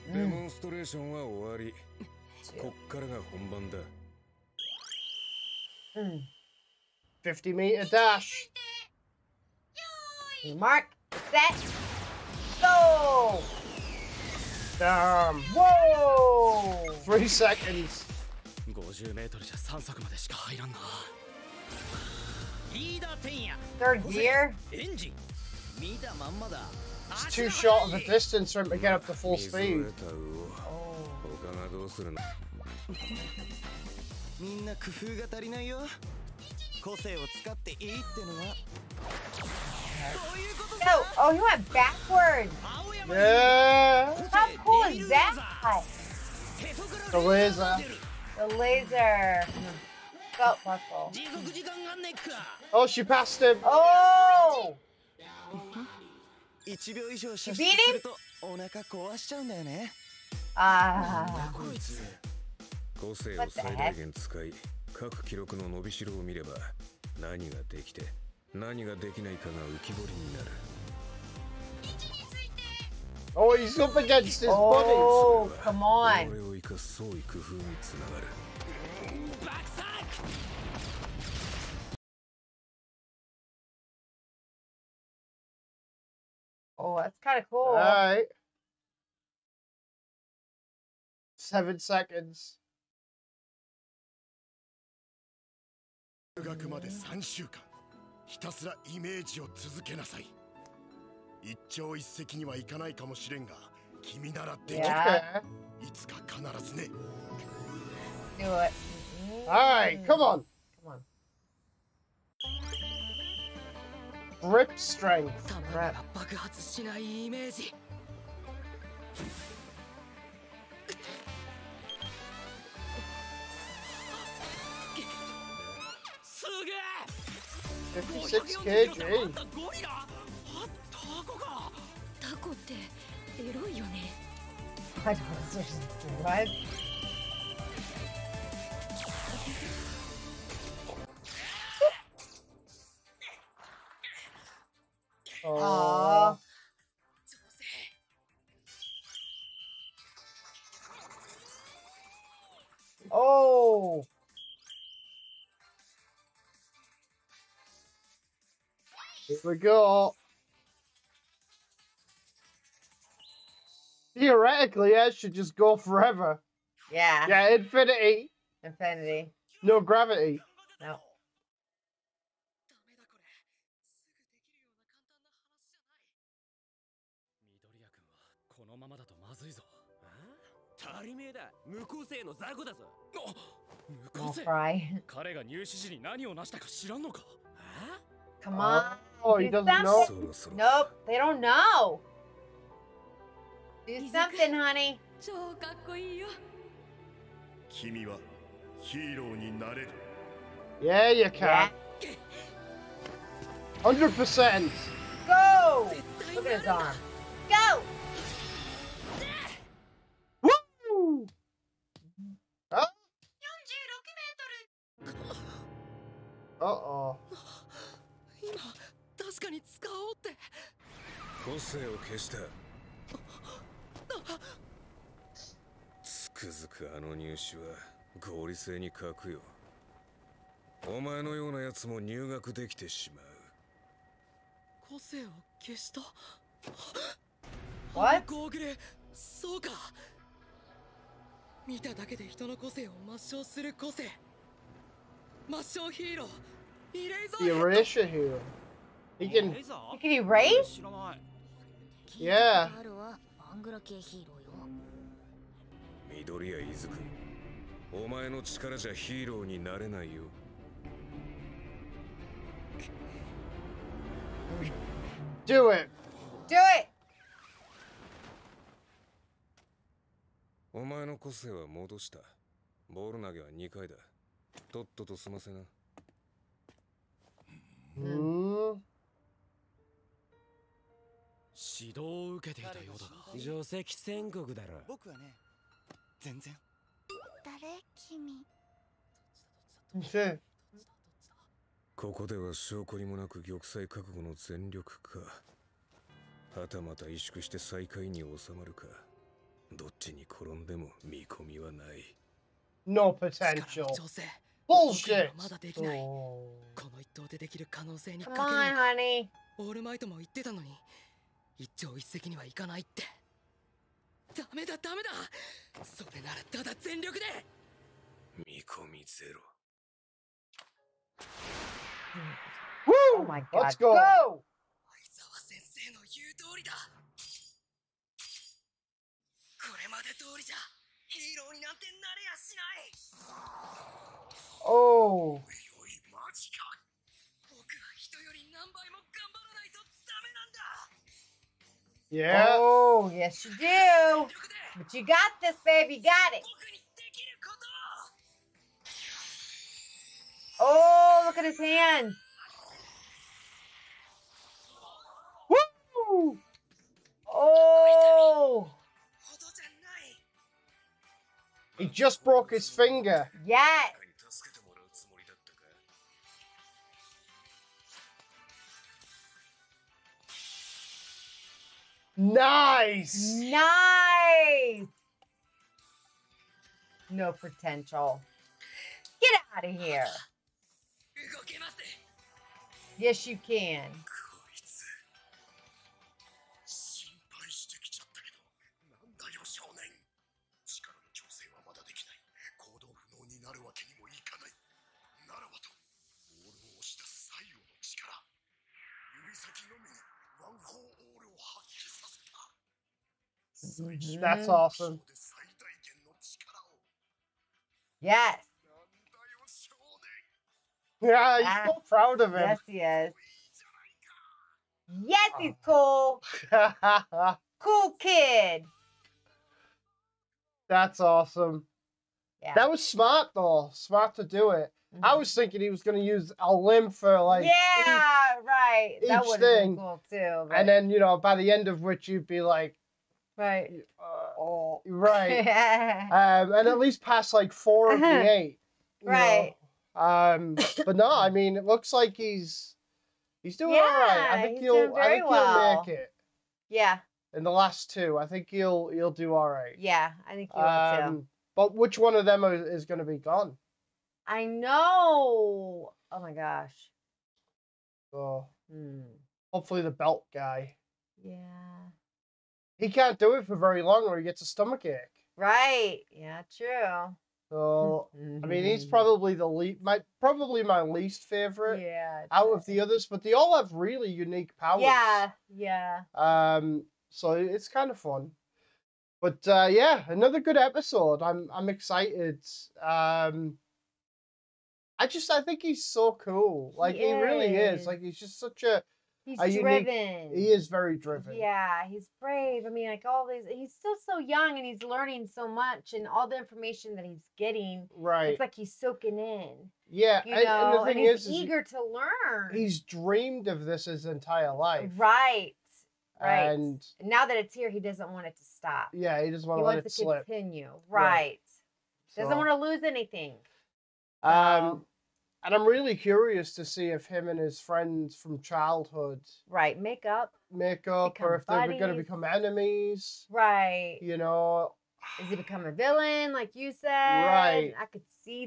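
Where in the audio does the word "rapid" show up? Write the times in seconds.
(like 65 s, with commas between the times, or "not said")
not said.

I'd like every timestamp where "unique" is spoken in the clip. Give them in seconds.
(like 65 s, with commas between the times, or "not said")
474 s, 489 s.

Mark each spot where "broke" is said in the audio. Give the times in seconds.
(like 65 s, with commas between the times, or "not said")
362 s.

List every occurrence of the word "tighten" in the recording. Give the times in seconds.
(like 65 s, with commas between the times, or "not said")
not said.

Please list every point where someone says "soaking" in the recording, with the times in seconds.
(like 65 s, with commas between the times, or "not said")
498 s.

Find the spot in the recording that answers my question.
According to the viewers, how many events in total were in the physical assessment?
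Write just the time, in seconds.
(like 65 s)
438 s.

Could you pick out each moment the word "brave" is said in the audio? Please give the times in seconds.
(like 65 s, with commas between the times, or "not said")
492 s.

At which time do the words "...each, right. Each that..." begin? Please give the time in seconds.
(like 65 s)
427 s.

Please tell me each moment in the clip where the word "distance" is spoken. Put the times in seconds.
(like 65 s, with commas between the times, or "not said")
28 s.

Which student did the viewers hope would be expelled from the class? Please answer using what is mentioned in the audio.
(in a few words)
the belt guy.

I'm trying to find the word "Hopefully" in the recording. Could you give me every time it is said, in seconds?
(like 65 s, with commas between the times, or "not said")
459 s.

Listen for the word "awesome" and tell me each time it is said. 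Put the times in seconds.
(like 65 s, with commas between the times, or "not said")
404 s, 420 s.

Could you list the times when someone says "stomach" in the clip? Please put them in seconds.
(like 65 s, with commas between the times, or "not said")
464 s.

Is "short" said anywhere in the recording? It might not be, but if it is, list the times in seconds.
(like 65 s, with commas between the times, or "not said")
27 s.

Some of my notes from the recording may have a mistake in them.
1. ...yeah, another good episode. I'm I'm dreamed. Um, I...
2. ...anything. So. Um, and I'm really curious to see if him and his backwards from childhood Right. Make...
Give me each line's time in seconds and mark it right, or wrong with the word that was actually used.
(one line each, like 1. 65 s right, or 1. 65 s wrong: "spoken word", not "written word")
1. 479 s wrong: "excited", not "dreamed"
2. 512 s wrong: "friends", not "backwards".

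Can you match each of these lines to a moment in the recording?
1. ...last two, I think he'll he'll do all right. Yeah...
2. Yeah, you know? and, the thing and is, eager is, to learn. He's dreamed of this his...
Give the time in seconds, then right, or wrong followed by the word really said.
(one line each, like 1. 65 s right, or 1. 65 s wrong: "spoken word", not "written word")
1. 447 s right
2. 499 s right.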